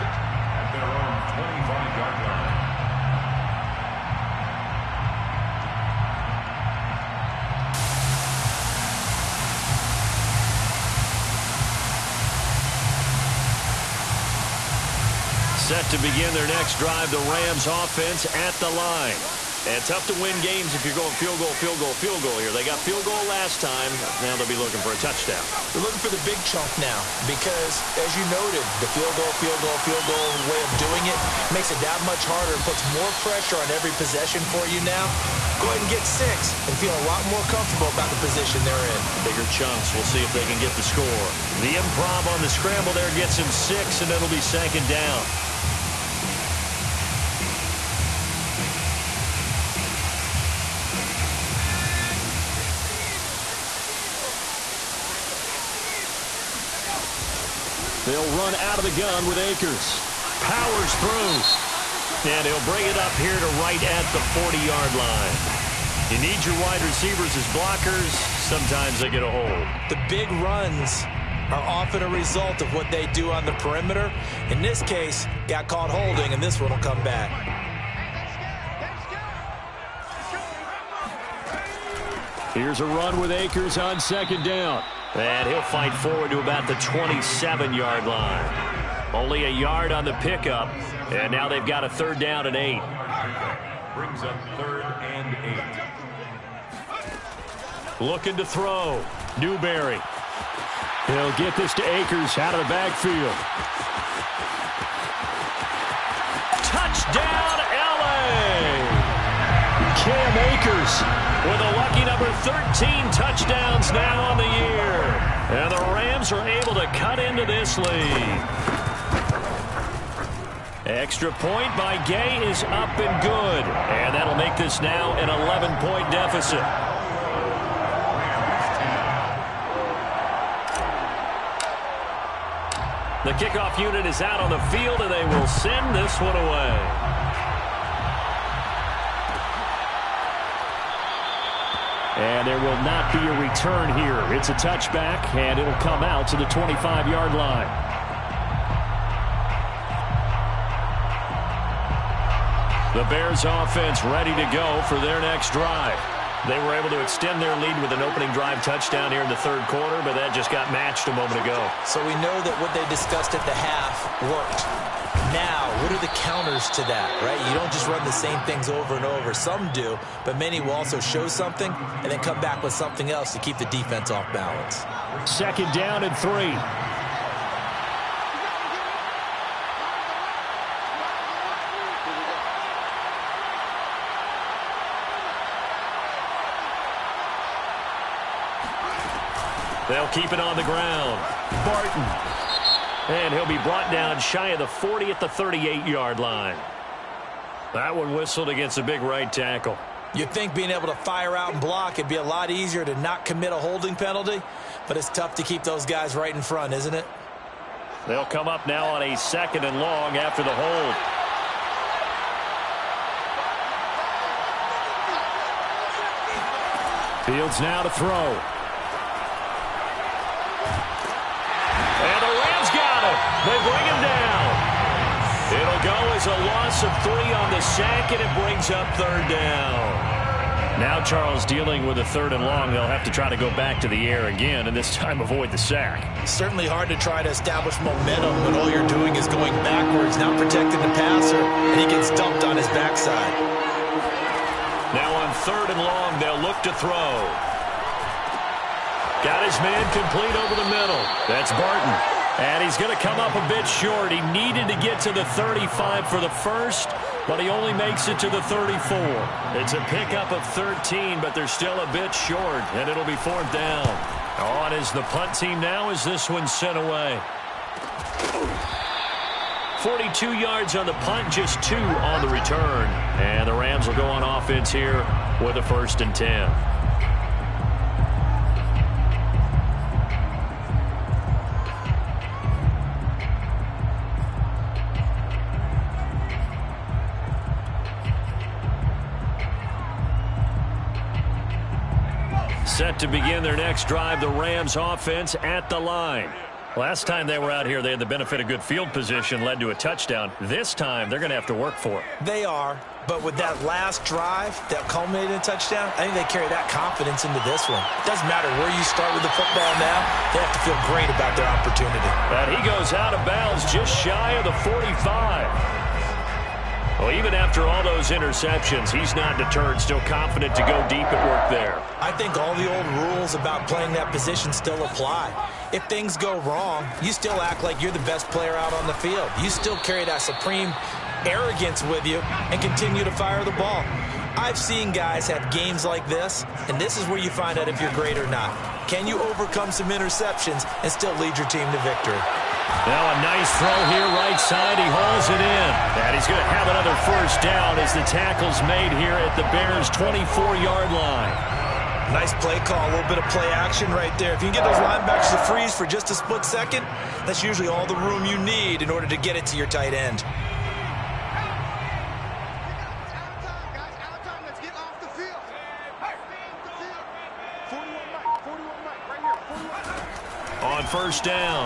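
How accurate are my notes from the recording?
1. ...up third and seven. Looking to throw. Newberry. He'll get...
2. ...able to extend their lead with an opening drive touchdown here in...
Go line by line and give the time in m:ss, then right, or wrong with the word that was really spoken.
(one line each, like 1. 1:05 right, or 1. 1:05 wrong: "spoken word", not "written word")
1. 1:34 wrong: "eight", not "seven"
2. 2:36 right.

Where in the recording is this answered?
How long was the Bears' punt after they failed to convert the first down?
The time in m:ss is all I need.
4:29.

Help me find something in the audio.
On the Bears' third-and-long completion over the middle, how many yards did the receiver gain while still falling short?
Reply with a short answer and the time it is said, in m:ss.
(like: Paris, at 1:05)
13, at 4:19.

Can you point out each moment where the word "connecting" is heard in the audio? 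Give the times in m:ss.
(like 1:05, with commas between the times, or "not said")
not said.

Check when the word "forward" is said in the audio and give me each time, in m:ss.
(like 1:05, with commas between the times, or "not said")
1:25.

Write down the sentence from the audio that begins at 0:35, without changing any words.
Go ahead and get six and feel a lot more comfortable about the position they're in.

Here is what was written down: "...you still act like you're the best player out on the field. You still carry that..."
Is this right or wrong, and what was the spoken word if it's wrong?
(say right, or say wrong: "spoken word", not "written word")
right.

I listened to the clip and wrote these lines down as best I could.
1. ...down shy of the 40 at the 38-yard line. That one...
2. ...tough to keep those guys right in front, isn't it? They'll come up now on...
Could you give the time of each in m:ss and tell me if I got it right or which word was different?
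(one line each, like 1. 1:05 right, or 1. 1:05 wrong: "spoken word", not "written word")
1. 3:13 right
2. 3:25 right.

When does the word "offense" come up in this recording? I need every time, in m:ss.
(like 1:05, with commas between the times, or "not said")
0:17, 2:33, 4:34, 4:54.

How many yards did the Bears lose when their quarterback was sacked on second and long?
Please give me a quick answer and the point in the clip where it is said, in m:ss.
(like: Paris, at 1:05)
3, at 3:46.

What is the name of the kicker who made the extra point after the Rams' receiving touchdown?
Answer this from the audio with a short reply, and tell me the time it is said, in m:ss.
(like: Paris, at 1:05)
Gay, at 2:02.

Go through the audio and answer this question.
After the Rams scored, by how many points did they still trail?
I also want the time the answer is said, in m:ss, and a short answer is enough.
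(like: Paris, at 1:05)
11, at 2:05.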